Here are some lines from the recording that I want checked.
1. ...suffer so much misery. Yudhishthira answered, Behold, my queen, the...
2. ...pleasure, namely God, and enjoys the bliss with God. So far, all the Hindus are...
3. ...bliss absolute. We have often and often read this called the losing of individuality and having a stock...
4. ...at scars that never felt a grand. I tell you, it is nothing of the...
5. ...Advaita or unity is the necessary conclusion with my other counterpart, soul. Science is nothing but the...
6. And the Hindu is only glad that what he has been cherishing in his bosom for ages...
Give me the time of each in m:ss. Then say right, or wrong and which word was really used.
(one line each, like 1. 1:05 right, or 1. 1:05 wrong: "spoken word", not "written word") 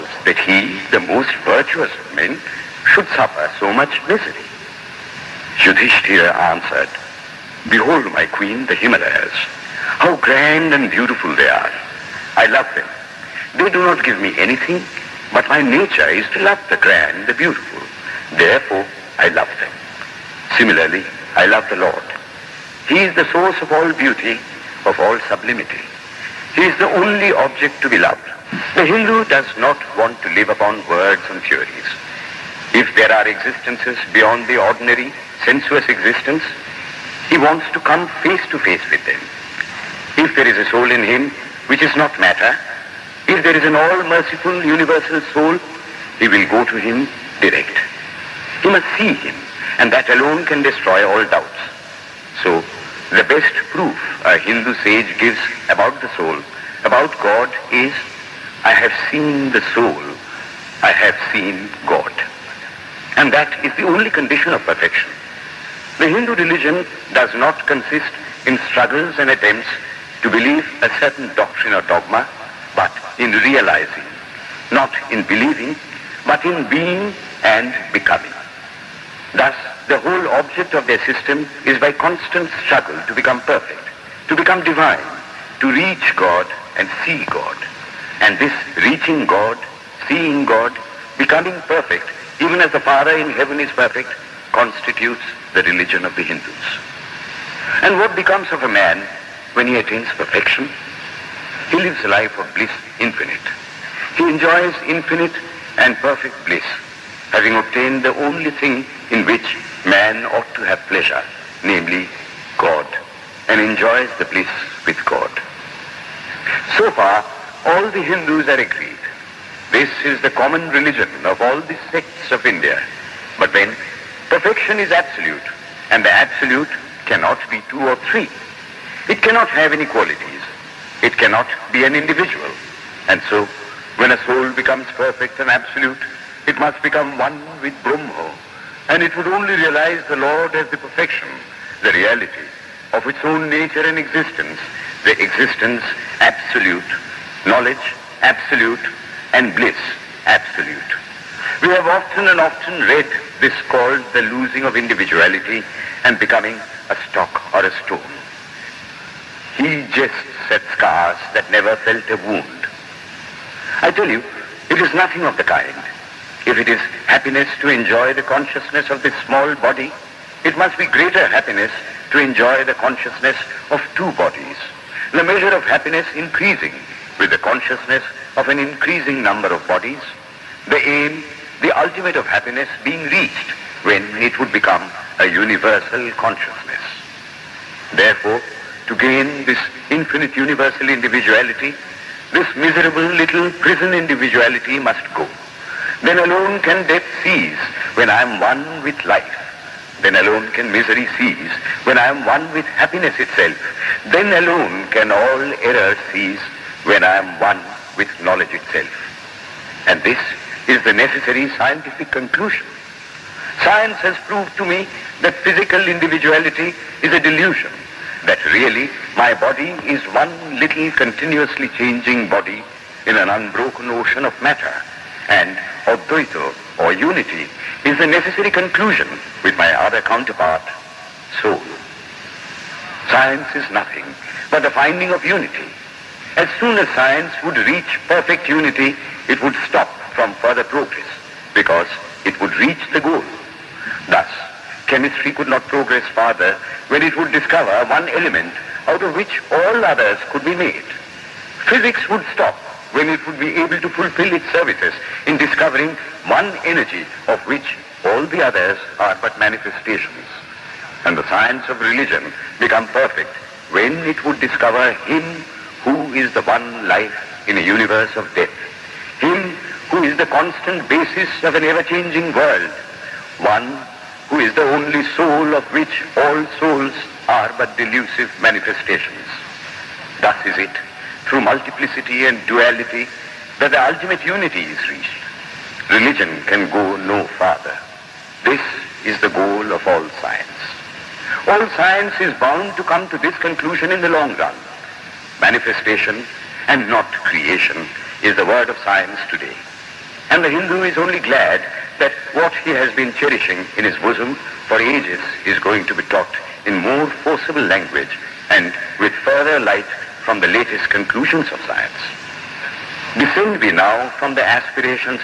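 1. 0:03 right
2. 1:50 right
3. 2:29 wrong: "becoming", not "having"
4. 2:40 wrong: "wound", not "grand"
5. 3:45 right
6. 5:00 right.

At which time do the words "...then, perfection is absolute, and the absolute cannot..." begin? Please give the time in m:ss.
2:03.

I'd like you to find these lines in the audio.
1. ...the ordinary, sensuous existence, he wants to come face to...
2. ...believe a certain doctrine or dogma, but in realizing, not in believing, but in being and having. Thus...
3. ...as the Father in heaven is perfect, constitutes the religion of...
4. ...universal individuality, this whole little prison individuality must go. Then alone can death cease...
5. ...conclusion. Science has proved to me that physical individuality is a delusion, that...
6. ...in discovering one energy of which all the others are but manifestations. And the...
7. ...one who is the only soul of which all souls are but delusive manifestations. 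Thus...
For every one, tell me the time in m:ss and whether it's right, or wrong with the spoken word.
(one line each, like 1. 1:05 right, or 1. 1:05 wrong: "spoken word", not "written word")
1. 0:34 right
2. 1:10 wrong: "becoming", not "having"
3. 1:32 right
4. 3:10 wrong: "miserable", not "whole"
5. 3:32 right
6. 4:15 right
7. 4:33 right.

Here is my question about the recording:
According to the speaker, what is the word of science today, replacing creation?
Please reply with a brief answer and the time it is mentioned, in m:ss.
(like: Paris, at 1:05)
Manifestation, at 4:55.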